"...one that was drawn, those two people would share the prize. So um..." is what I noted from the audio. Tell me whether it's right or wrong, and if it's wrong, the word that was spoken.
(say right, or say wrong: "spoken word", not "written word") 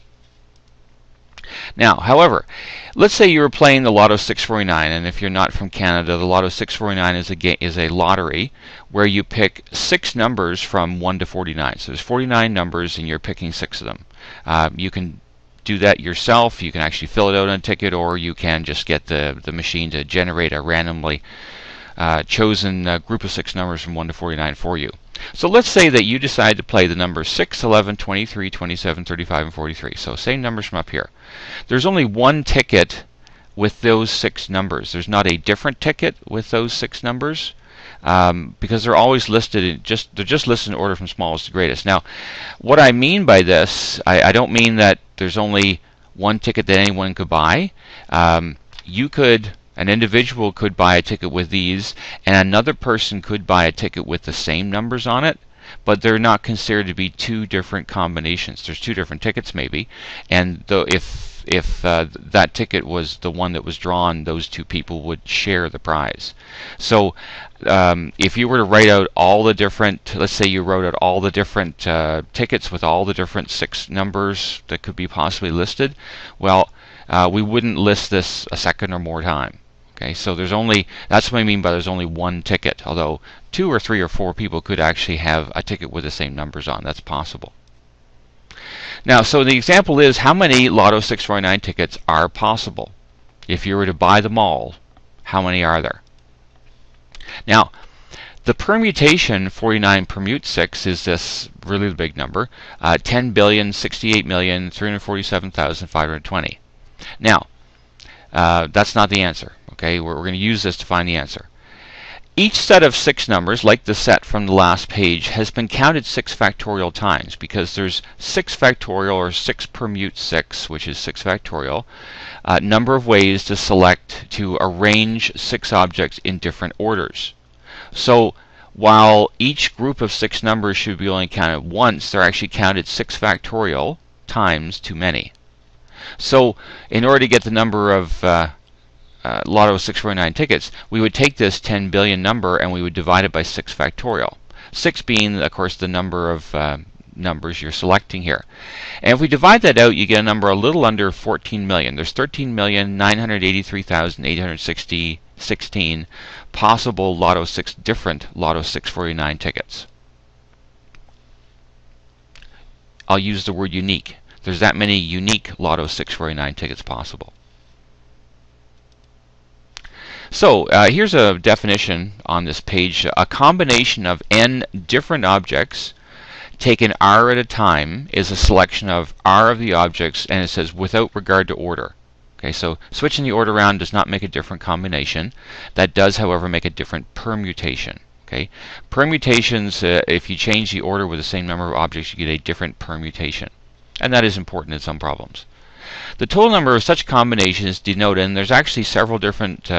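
right.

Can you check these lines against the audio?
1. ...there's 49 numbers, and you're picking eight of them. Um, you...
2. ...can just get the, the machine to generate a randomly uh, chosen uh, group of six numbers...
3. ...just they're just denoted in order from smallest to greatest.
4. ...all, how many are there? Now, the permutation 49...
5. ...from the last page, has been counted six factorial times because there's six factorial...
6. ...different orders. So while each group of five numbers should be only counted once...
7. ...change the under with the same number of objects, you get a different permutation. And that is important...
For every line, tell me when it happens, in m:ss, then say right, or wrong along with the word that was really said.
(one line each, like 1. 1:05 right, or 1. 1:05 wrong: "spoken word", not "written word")
1. 0:11 wrong: "six", not "eight"
2. 0:18 right
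3. 0:39 wrong: "listed", not "denoted"
4. 1:34 right
5. 1:54 right
6. 2:06 wrong: "six", not "five"
7. 3:10 wrong: "order", not "under".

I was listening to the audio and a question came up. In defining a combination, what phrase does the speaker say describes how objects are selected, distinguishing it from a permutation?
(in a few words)
Without regard to order.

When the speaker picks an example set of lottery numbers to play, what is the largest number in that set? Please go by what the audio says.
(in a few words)
43.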